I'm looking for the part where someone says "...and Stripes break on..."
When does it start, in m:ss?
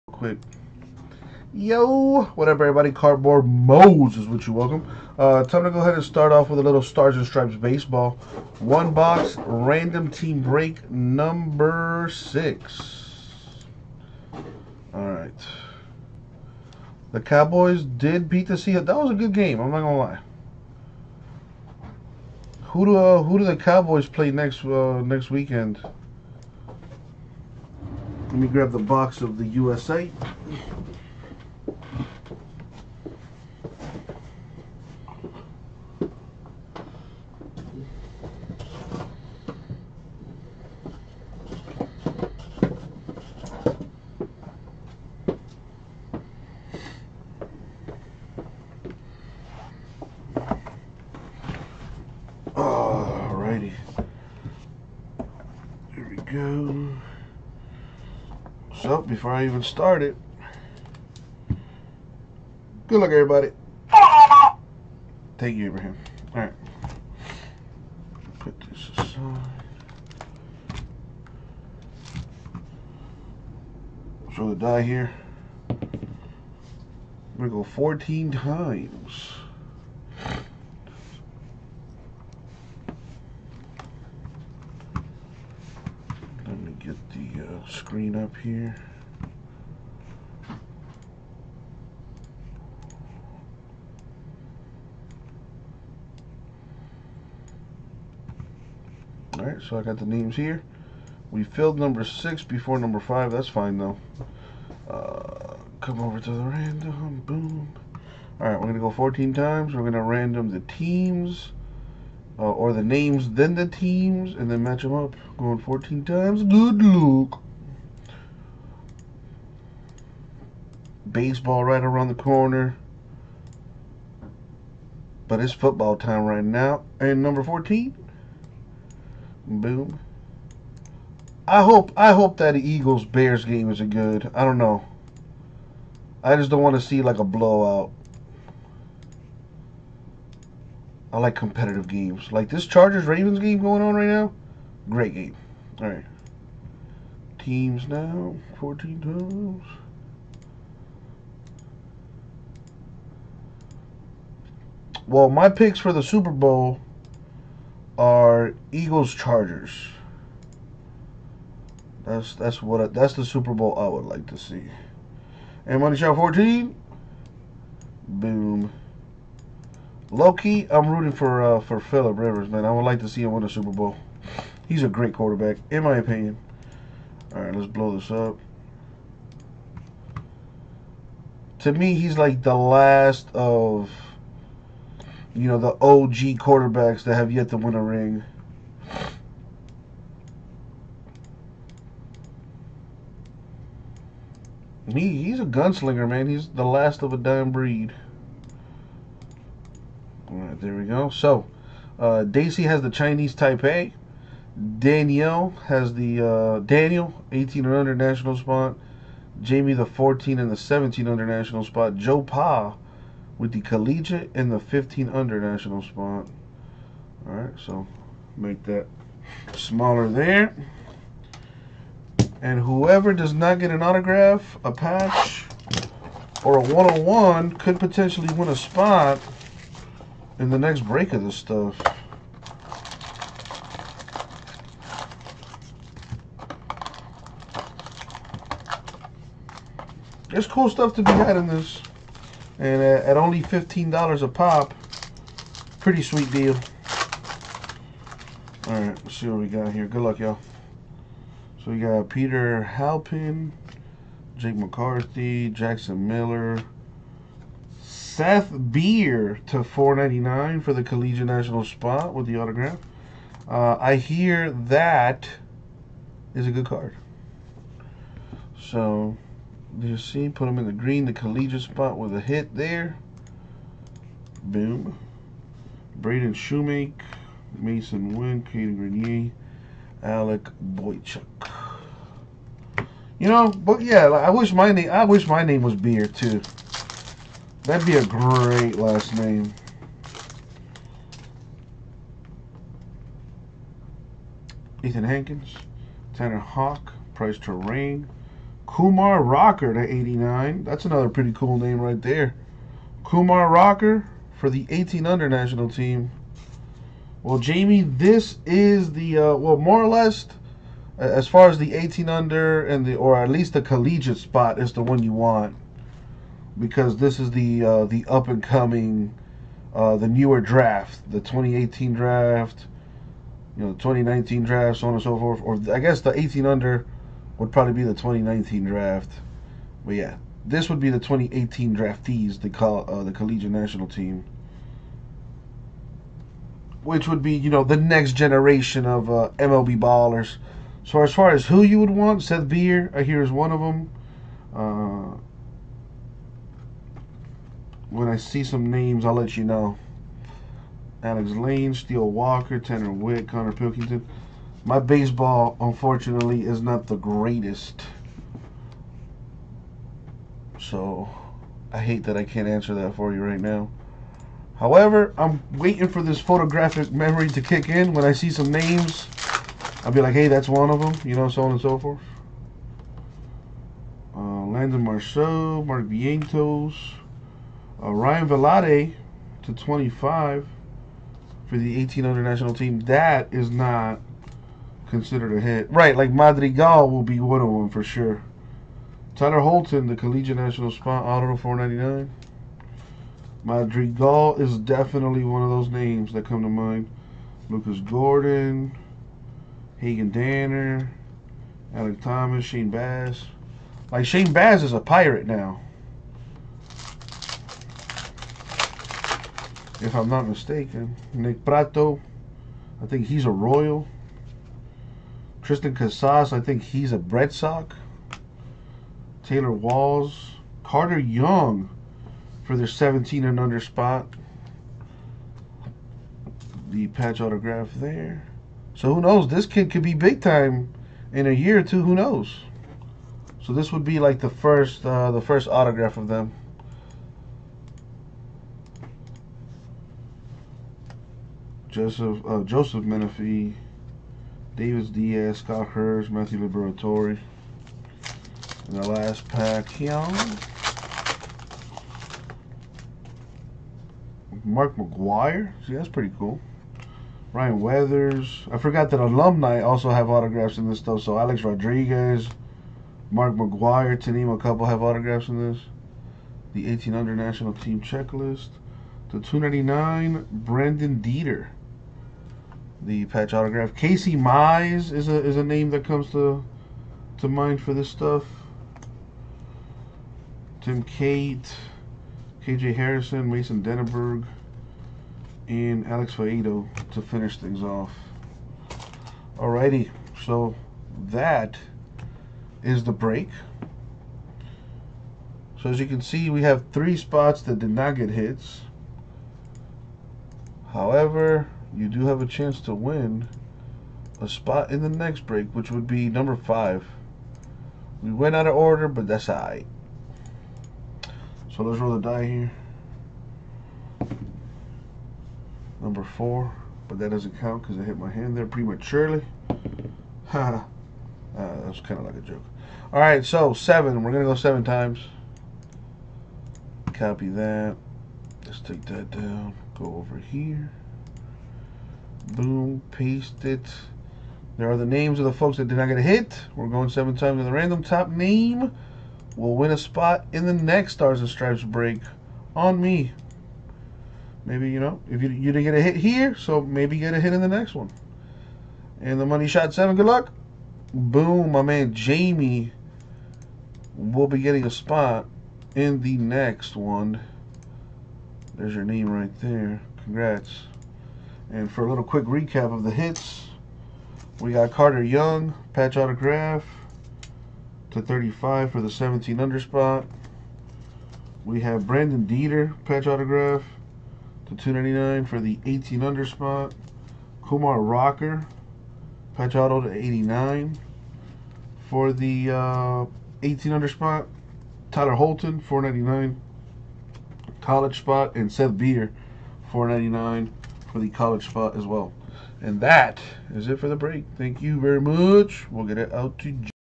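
9:01.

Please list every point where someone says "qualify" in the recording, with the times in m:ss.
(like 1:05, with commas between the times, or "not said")
not said.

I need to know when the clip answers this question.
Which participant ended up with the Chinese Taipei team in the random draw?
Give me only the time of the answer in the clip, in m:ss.
3:22.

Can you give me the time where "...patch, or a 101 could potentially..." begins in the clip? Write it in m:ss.
3:44.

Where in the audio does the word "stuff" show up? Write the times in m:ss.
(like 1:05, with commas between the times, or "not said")
3:51, 4:00, 7:40, 7:57.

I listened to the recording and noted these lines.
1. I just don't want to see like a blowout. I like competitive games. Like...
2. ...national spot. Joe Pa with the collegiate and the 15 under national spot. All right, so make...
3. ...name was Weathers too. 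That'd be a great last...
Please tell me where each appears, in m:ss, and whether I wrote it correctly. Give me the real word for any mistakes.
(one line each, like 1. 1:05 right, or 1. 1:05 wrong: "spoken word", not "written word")
1. 2:16 right
2. 3:31 right
3. 4:45 wrong: "Beer", not "Weathers".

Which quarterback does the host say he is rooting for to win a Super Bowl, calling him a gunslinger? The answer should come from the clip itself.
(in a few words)
Philip Rivers.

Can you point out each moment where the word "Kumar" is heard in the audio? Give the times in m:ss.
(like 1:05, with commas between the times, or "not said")
4:58, 5:03, 9:37.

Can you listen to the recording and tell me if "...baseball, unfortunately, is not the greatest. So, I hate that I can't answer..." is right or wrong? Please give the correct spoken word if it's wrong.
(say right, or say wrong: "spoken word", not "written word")
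right.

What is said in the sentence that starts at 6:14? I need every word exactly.
Uh, Landon Marceaux, Mark Vientos, uh, Ryan Vilade to 25 for the 1800 national team.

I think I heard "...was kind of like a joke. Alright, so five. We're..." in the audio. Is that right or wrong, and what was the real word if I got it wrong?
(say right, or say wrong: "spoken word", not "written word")
wrong: "seven", not "five".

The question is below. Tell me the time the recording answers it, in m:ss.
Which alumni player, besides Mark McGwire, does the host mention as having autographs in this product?
7:41.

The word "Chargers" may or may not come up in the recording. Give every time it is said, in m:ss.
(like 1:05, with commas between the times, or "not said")
2:22, 2:39.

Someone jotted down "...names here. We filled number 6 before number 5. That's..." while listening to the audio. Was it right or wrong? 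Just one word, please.
right.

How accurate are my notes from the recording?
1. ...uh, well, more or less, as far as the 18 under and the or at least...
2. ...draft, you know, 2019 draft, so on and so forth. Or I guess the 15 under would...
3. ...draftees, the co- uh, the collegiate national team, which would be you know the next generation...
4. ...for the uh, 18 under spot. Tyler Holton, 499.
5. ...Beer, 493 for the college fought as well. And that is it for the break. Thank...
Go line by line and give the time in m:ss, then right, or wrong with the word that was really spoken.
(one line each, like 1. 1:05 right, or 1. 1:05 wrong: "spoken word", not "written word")
1. 5:09 right
2. 5:21 wrong: "18", not "15"
3. 5:31 right
4. 9:41 right
5. 9:48 wrong: "499", not "493".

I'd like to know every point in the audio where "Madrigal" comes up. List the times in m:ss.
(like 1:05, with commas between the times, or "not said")
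6:26, 6:33.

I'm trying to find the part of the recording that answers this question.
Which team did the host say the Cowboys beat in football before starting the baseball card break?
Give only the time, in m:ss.
0:18.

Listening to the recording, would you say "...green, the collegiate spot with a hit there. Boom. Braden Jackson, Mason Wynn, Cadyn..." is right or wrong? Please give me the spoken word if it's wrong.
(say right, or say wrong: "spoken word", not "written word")
wrong: "Shewmake", not "Jackson".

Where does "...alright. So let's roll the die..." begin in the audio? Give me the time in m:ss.
8:29.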